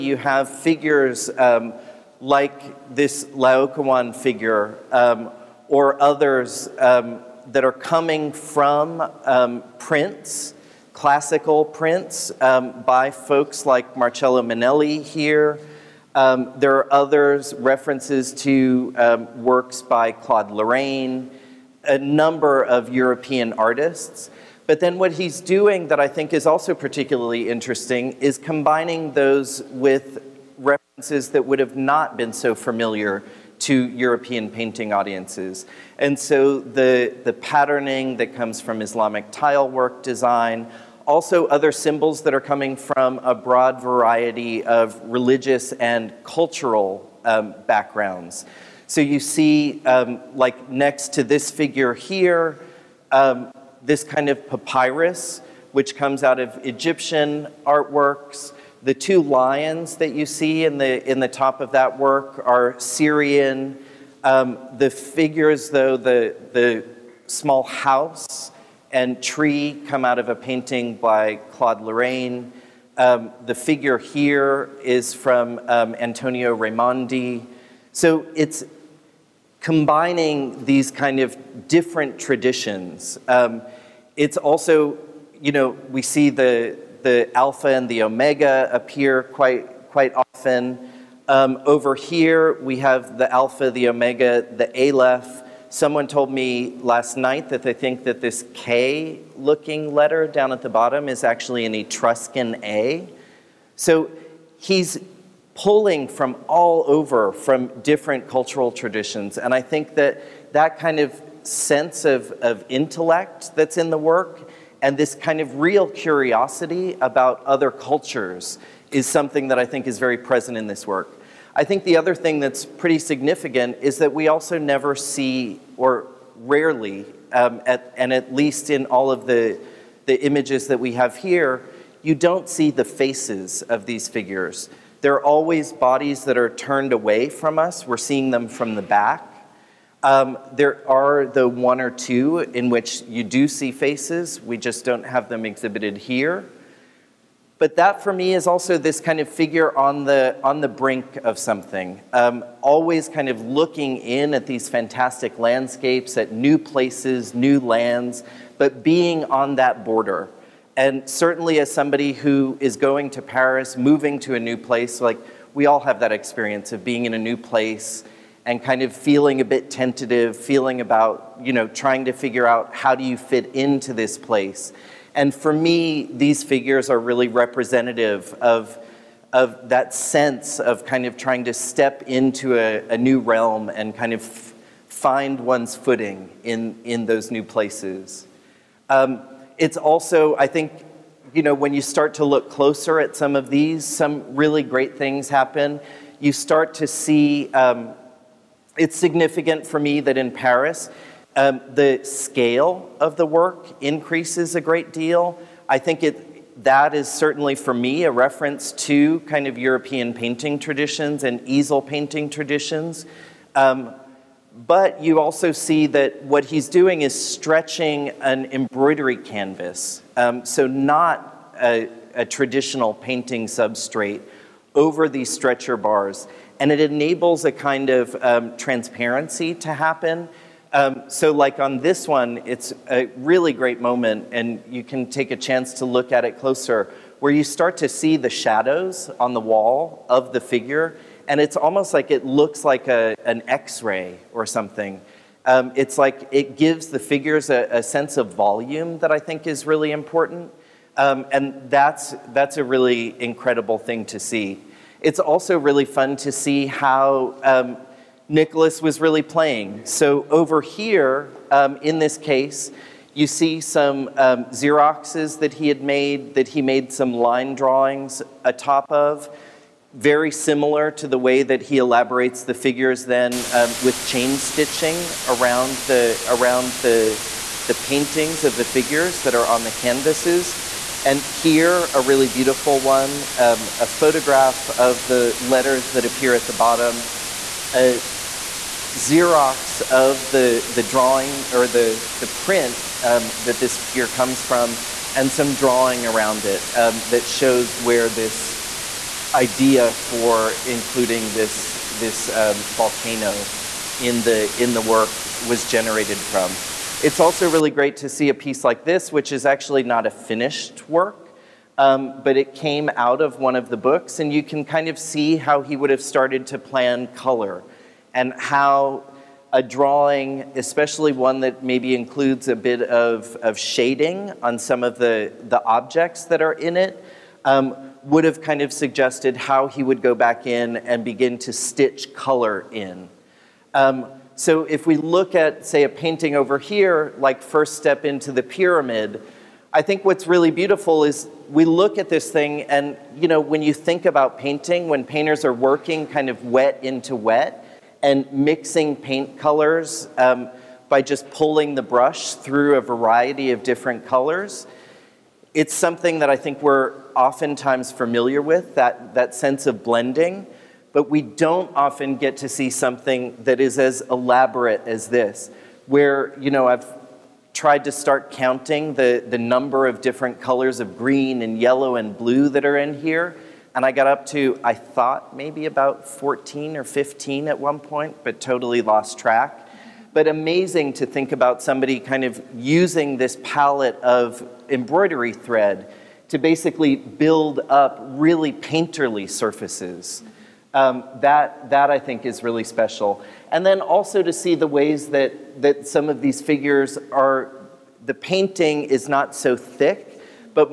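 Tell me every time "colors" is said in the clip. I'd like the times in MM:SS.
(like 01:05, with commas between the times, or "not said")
05:17, 05:32, 05:49, 05:54, 06:10.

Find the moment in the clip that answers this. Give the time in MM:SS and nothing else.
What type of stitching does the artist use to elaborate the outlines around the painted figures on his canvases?
04:34.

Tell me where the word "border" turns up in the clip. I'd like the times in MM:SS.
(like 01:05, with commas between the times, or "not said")
02:39.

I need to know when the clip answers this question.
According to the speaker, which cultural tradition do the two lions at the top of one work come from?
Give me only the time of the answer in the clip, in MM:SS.
01:02.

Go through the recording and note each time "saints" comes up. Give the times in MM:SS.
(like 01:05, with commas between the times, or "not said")
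not said.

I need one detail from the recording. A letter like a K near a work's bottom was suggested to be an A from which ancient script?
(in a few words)
Etruscan.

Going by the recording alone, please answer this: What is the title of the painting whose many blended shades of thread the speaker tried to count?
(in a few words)
First Step into the Pyramid.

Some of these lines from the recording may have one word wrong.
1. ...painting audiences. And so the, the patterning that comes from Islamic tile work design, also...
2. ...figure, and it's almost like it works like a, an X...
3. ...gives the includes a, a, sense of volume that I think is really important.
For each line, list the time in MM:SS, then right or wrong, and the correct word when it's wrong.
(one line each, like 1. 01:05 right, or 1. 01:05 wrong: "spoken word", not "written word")
1. 00:34 right
2. 04:00 wrong: "looks", not "works"
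3. 04:06 wrong: "figures", not "includes".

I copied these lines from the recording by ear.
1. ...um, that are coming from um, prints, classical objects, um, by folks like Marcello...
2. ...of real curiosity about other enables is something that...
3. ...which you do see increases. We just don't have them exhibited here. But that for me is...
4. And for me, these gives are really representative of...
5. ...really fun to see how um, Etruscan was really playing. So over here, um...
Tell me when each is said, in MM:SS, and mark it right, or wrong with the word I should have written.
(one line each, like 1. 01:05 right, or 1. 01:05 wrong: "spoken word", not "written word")
1. 00:06 wrong: "prints", not "objects"
2. 01:55 wrong: "cultures", not "enables"
3. 02:22 wrong: "faces", not "increases"
4. 02:55 wrong: "figures", not "gives"
5. 04:15 wrong: "Nicolas", not "Etruscan".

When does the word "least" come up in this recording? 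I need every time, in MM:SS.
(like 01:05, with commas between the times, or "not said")
02:08.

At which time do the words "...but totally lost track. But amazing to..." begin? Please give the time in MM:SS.
06:18.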